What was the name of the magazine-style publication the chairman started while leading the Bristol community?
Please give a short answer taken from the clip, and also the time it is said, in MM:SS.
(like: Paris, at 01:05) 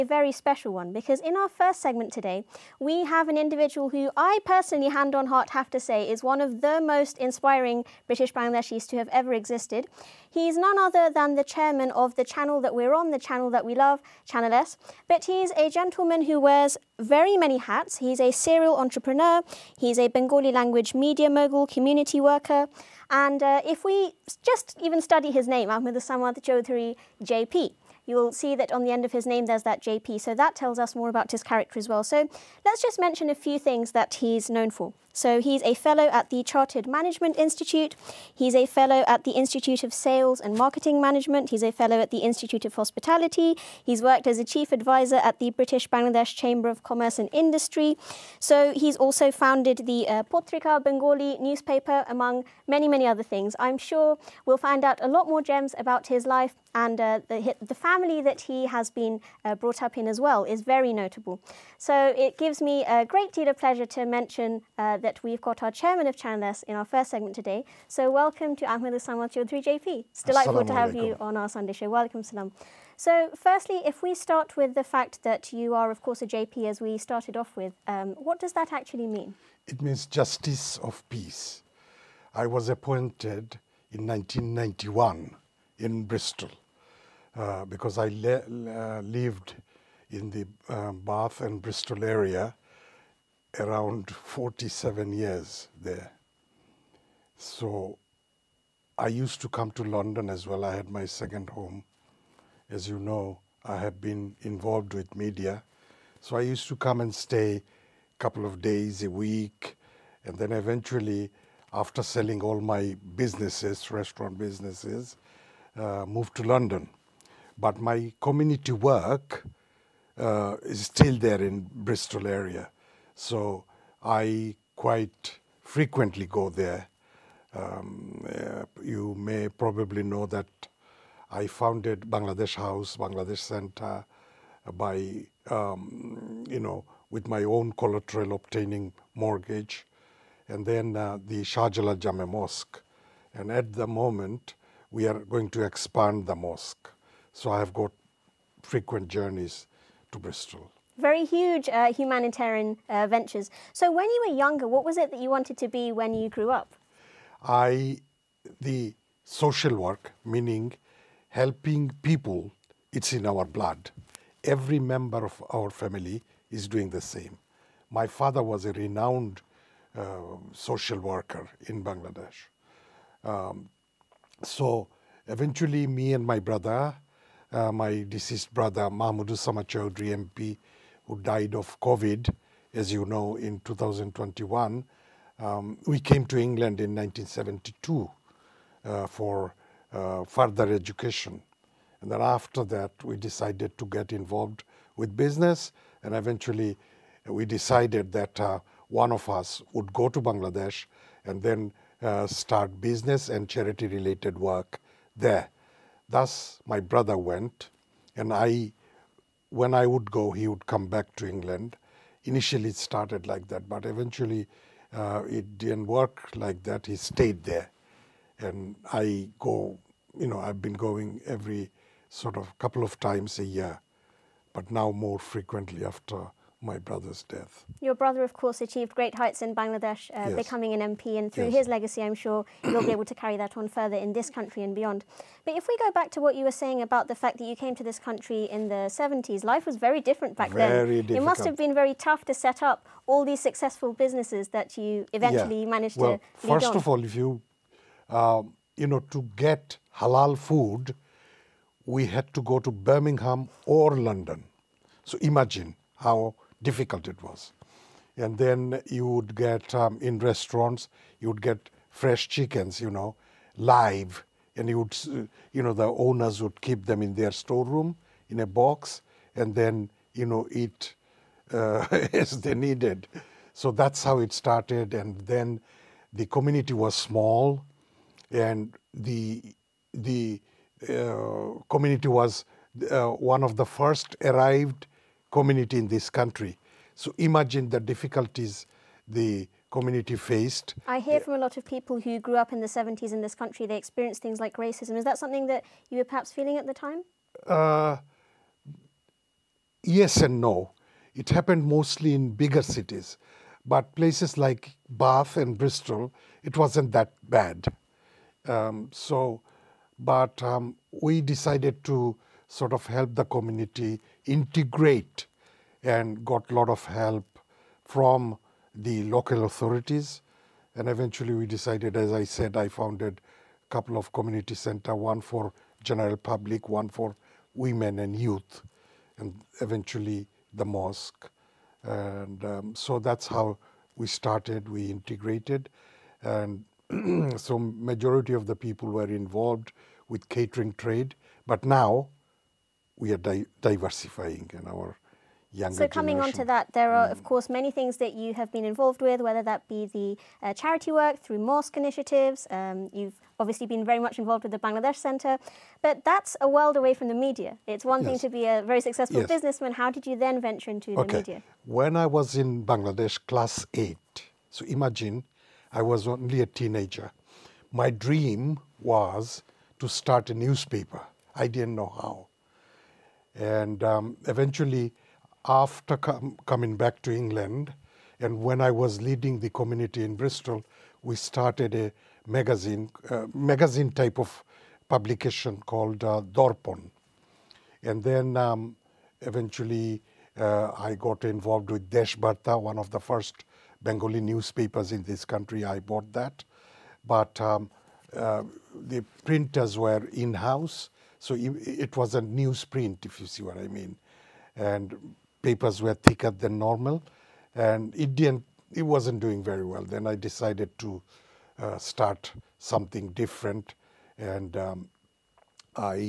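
Dorpon, at 06:26.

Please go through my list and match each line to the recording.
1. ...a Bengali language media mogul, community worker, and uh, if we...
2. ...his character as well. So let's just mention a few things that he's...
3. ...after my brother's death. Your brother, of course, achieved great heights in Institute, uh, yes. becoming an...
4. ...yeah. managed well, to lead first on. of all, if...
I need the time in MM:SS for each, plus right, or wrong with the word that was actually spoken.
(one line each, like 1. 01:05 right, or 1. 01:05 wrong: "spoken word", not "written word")
1. 00:19 right
2. 00:31 right
3. 03:45 wrong: "Bangladesh", not "Institute"
4. 04:05 right.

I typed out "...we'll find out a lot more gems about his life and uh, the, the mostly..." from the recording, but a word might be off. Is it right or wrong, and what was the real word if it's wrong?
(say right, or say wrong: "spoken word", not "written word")
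wrong: "family", not "mostly".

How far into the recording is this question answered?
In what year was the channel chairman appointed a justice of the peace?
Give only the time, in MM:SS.
01:24.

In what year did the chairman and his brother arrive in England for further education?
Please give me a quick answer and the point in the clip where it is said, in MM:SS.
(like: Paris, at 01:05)
1972, at 03:06.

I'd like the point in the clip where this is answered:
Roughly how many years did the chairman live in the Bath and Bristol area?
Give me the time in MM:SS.
01:34.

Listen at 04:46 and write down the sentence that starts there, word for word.
So imagine the difficulties the community faced.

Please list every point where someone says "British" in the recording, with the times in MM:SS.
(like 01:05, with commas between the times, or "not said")
00:08, 00:45.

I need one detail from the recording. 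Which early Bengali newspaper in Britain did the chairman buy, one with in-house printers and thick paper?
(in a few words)
Deshbarta.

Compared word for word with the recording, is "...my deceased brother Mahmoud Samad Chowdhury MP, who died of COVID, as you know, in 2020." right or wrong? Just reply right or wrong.
wrong.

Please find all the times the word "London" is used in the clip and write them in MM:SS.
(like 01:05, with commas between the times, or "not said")
01:39, 01:56, 04:13.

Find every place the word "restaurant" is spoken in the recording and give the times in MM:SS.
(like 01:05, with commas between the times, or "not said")
01:53, 04:20.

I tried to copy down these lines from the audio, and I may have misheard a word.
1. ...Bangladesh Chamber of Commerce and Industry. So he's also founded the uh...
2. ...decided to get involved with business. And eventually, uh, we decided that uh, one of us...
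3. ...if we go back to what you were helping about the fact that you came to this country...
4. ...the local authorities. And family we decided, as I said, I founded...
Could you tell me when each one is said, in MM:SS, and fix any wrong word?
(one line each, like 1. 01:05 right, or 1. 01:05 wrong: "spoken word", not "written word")
1. 00:45 right
2. 03:13 right
3. 03:55 wrong: "saying", not "helping"
4. 05:18 wrong: "eventually", not "family".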